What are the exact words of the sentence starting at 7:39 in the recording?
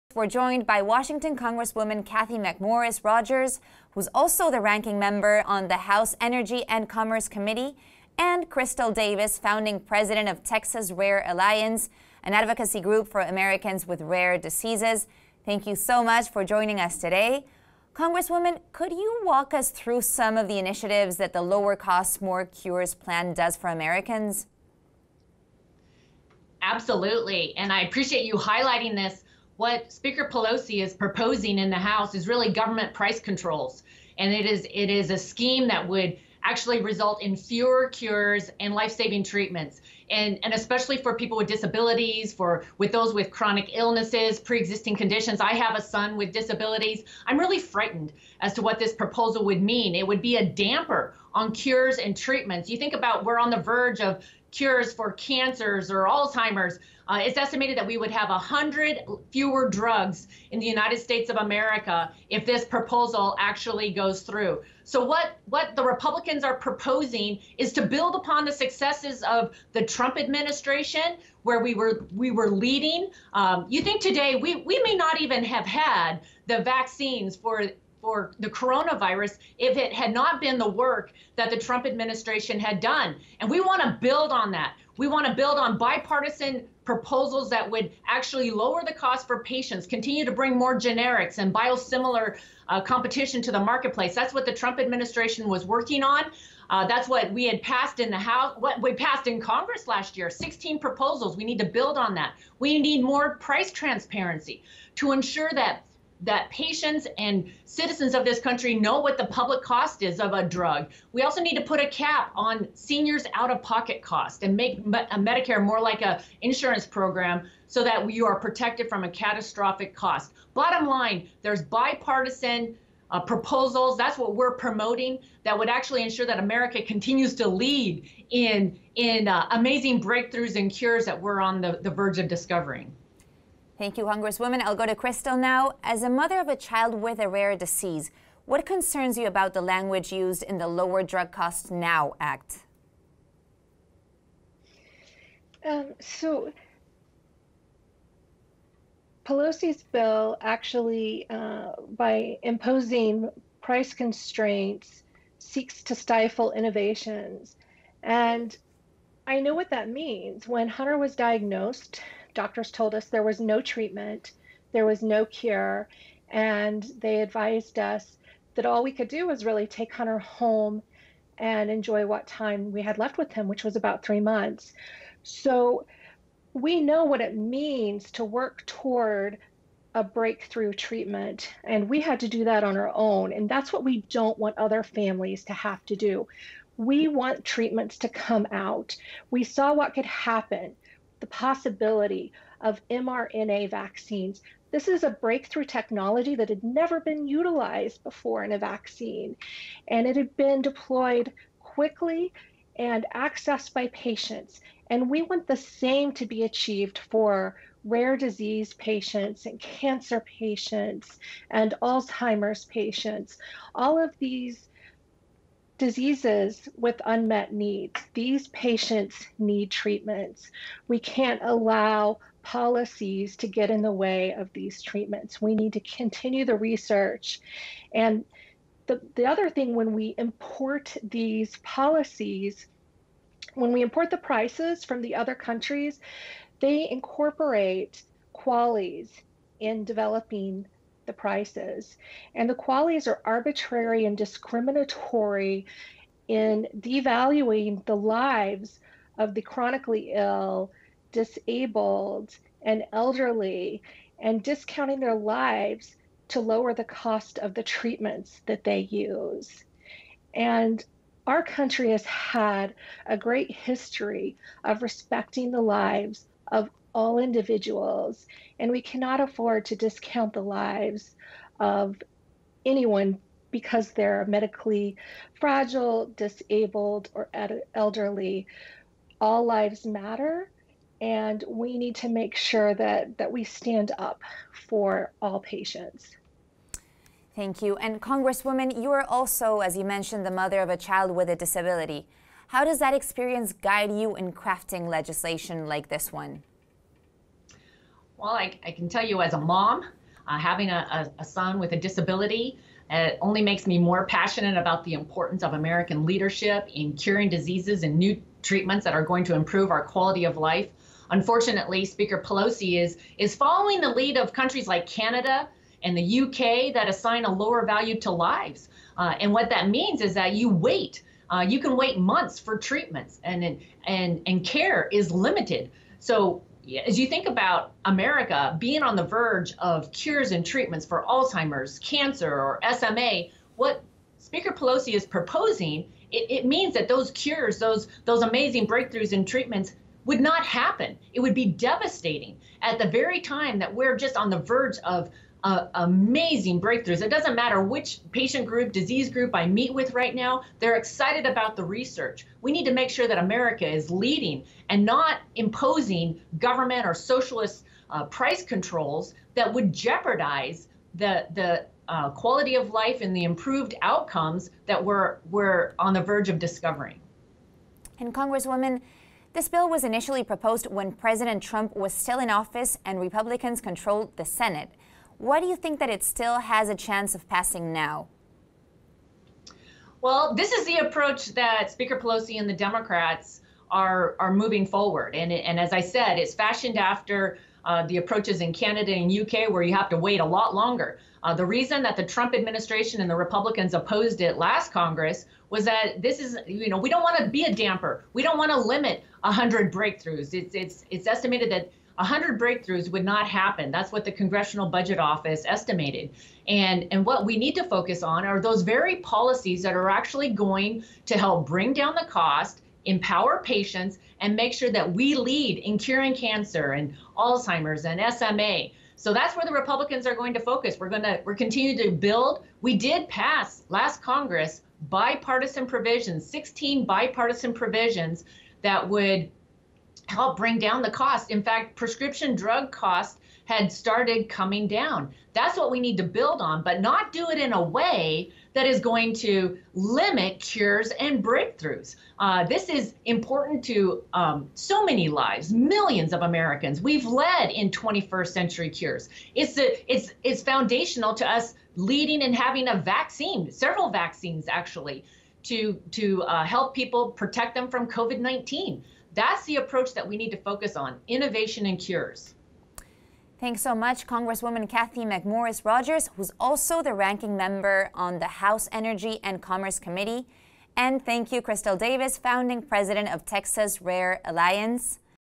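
That's the approach that we need to focus on innovation and cures.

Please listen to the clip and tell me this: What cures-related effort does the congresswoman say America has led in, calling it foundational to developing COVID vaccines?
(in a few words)
21st Century Cures.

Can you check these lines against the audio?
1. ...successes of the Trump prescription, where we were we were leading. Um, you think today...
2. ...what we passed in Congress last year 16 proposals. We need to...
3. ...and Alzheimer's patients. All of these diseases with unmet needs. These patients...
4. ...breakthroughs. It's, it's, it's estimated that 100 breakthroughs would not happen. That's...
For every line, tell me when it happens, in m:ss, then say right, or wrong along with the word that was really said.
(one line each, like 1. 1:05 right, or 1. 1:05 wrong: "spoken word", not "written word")
1. 1:08 wrong: "administration", not "prescription"
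2. 1:38 right
3. 3:31 right
4. 6:39 right.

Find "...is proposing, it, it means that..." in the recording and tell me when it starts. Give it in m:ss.
5:34.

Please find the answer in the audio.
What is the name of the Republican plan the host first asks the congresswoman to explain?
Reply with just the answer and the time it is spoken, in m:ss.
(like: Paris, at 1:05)
Lower Cost, More Cures, at 0:21.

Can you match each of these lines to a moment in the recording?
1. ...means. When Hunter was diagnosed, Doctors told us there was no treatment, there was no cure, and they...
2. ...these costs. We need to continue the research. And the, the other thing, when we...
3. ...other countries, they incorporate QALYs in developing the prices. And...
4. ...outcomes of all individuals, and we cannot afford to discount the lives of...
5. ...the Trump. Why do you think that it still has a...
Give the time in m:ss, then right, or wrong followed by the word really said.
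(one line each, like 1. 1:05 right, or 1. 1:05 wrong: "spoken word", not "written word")
1. 2:39 right
2. 3:44 wrong: "treatments", not "costs"
3. 3:55 right
4. 4:25 wrong: "lives", not "outcomes"
5. 6:14 wrong: "Senate", not "Trump".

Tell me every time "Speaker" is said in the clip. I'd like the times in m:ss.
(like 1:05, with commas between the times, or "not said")
0:29, 5:11, 5:34, 6:21.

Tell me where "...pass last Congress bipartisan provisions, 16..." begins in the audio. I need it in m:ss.
7:03.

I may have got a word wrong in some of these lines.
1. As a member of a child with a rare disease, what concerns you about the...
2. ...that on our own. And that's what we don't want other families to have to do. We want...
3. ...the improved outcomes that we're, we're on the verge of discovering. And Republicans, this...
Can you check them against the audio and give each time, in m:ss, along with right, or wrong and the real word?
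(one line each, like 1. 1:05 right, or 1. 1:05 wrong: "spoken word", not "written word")
1. 2:15 wrong: "mother", not "member"
2. 3:02 right
3. 6:03 wrong: "Congresswoman", not "Republicans".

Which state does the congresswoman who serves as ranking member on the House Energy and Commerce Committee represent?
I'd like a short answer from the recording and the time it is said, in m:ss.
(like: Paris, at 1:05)
Washington, at 0:00.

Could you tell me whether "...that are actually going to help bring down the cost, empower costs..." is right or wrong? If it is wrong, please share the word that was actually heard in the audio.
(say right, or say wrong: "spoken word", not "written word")
wrong: "patients", not "costs".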